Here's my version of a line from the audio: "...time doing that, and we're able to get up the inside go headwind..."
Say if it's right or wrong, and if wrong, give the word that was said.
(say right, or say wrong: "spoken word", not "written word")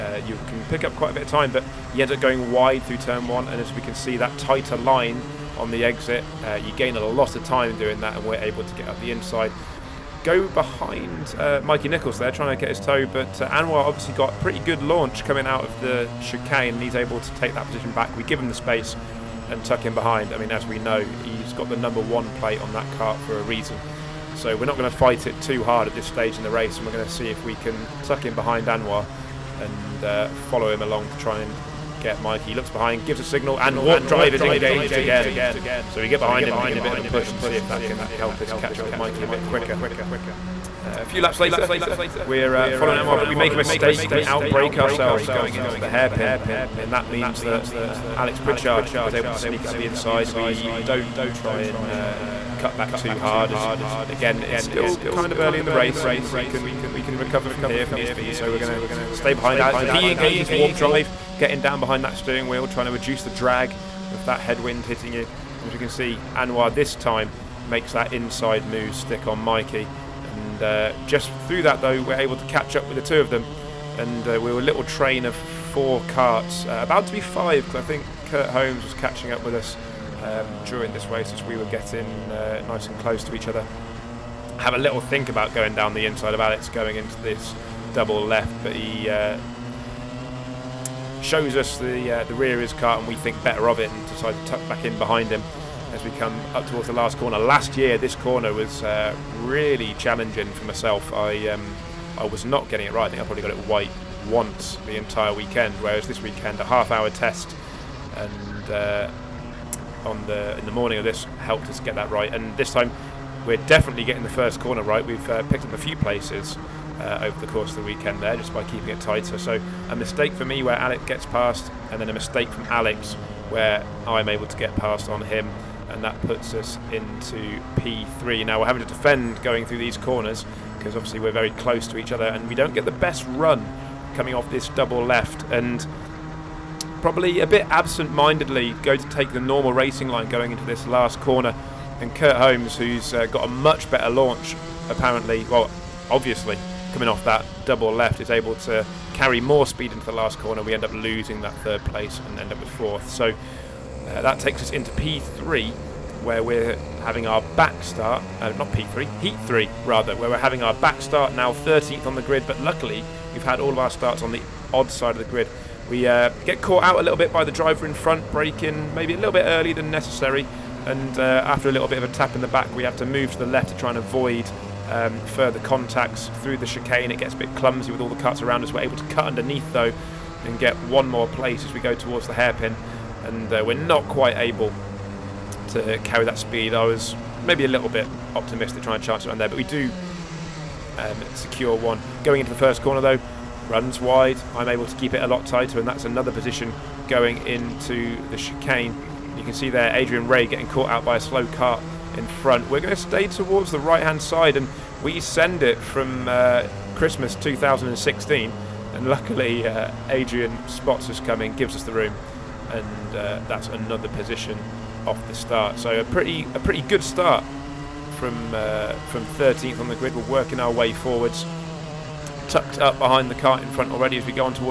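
wrong: "behind", not "headwind".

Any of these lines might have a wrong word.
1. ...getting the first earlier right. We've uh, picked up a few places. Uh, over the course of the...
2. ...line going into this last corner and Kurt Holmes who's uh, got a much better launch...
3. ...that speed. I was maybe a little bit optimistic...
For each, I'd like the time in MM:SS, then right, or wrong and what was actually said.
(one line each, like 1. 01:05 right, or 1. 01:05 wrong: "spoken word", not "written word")
1. 01:54 wrong: "corner", not "earlier"
2. 02:20 right
3. 03:06 right.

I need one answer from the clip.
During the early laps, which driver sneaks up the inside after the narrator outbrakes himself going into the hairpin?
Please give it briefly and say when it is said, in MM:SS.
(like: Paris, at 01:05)
Alex Pritchard, at 00:48.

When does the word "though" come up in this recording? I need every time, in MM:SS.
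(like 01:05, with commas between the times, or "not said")
01:11, 02:59, 03:13.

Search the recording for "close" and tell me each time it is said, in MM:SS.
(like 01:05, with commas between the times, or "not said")
01:22, 02:11.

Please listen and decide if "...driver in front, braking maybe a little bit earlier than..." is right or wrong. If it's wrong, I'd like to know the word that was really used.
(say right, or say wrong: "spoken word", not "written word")
right.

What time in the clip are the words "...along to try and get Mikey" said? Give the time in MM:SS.
00:30.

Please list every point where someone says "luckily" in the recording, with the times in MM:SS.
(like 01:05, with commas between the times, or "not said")
02:42, 03:29.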